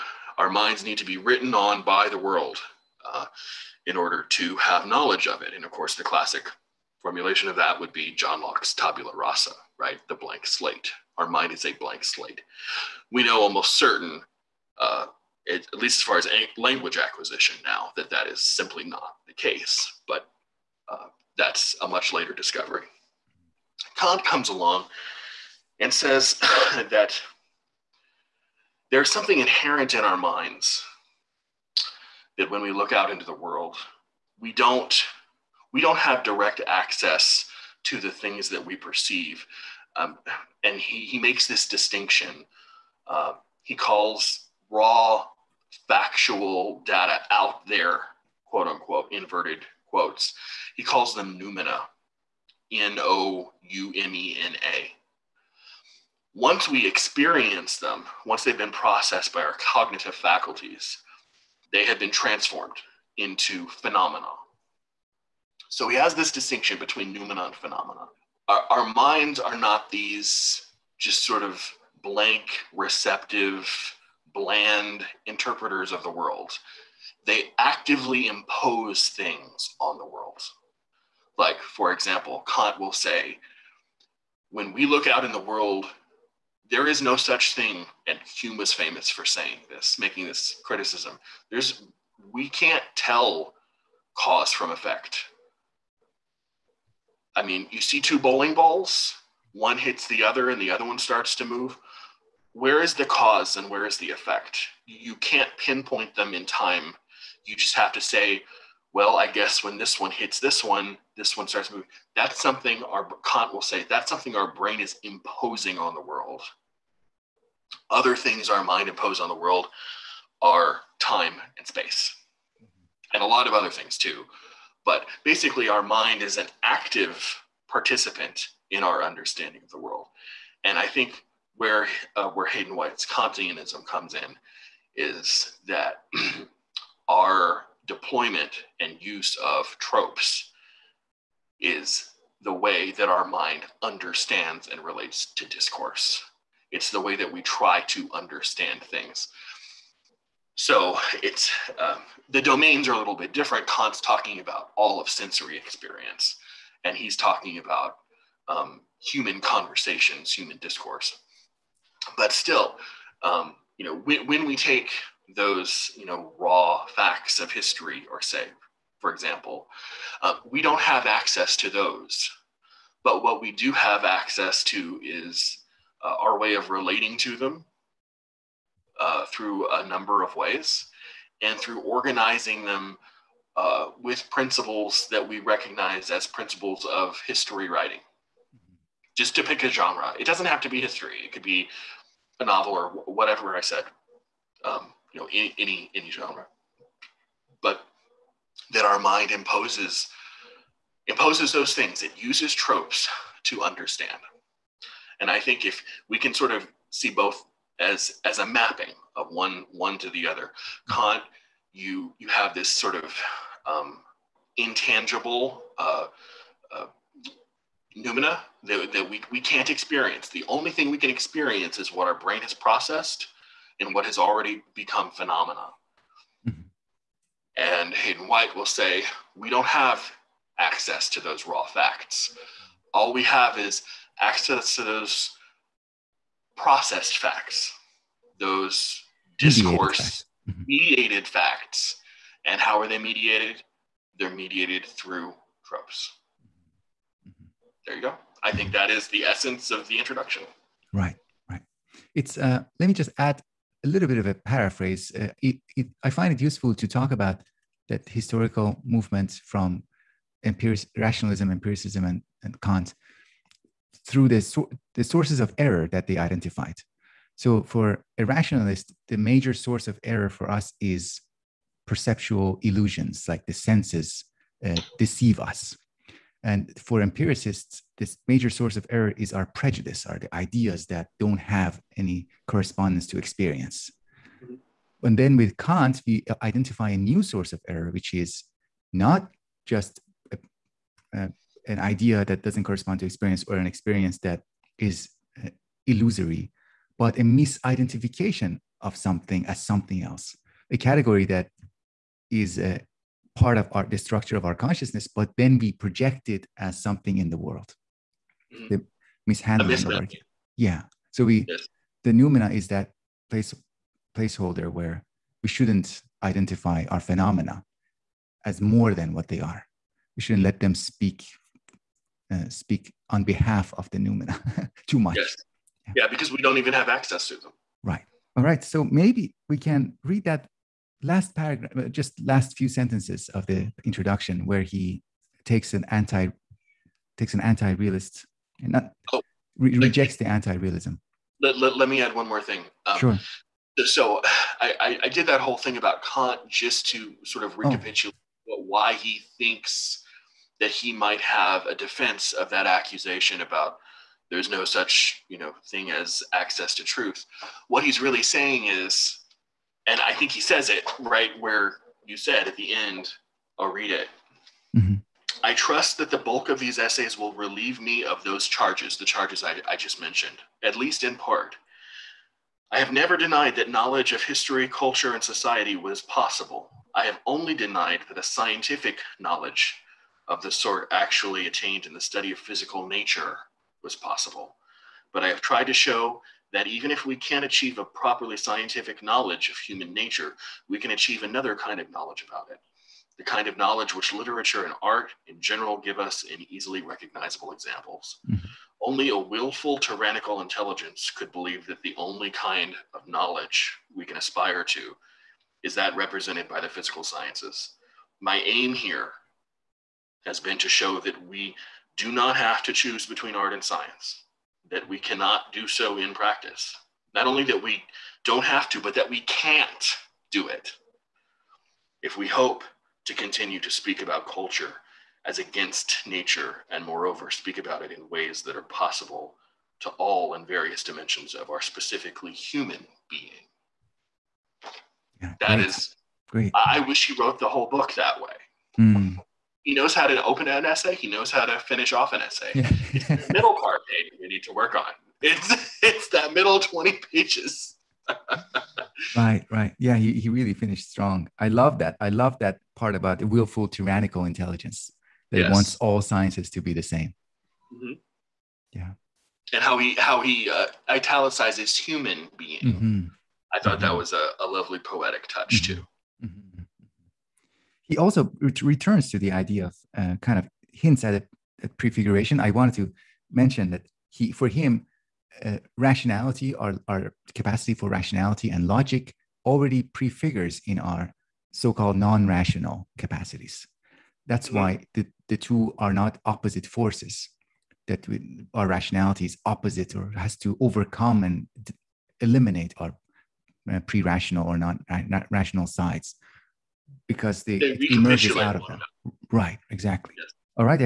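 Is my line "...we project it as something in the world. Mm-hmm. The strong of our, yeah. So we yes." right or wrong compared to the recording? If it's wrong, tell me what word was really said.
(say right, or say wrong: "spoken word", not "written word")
wrong: "mishandling", not "strong".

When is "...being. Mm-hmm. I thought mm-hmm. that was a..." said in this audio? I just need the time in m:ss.
7:42.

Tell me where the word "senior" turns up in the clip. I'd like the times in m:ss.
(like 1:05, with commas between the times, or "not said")
not said.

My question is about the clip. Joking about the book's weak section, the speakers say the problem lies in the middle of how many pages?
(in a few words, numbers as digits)
20.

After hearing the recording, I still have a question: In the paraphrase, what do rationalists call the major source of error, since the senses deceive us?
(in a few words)
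perceptual illusions.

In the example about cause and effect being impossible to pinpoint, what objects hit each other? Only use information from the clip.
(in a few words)
bowling balls.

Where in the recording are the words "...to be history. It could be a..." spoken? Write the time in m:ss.
3:10.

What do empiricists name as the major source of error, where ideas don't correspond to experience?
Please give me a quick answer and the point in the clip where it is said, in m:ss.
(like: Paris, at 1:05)
prejudice, at 4:39.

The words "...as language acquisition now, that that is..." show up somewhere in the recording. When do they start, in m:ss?
0:16.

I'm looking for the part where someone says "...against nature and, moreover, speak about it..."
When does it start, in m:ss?
7:05.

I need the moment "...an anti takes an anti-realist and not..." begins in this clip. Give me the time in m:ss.
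5:35.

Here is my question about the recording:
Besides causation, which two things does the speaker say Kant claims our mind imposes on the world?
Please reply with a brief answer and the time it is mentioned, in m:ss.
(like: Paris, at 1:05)
time and space, at 2:00.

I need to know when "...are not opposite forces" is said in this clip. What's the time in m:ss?
8:05.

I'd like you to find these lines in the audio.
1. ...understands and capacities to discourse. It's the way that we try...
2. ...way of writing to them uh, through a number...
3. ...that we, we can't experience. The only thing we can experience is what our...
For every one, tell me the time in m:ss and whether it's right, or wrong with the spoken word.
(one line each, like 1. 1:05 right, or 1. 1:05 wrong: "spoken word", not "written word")
1. 2:23 wrong: "relates", not "capacities"
2. 2:56 wrong: "relating", not "writing"
3. 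3:38 right.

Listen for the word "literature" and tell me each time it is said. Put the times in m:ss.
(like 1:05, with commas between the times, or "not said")
6:34.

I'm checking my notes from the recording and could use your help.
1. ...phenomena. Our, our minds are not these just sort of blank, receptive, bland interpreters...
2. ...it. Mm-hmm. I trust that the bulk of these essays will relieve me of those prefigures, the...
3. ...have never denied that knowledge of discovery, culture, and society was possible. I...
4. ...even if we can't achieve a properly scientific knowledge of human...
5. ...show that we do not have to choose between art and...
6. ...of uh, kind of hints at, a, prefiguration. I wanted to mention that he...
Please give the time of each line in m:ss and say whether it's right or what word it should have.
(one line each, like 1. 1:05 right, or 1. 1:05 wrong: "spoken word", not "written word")
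1. 1:07 right
2. 6:03 wrong: "charges", not "prefigures"
3. 6:12 wrong: "history", not "discovery"
4. 6:26 right
5. 6:50 right
6. 7:49 right.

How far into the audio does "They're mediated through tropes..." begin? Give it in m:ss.
4:04.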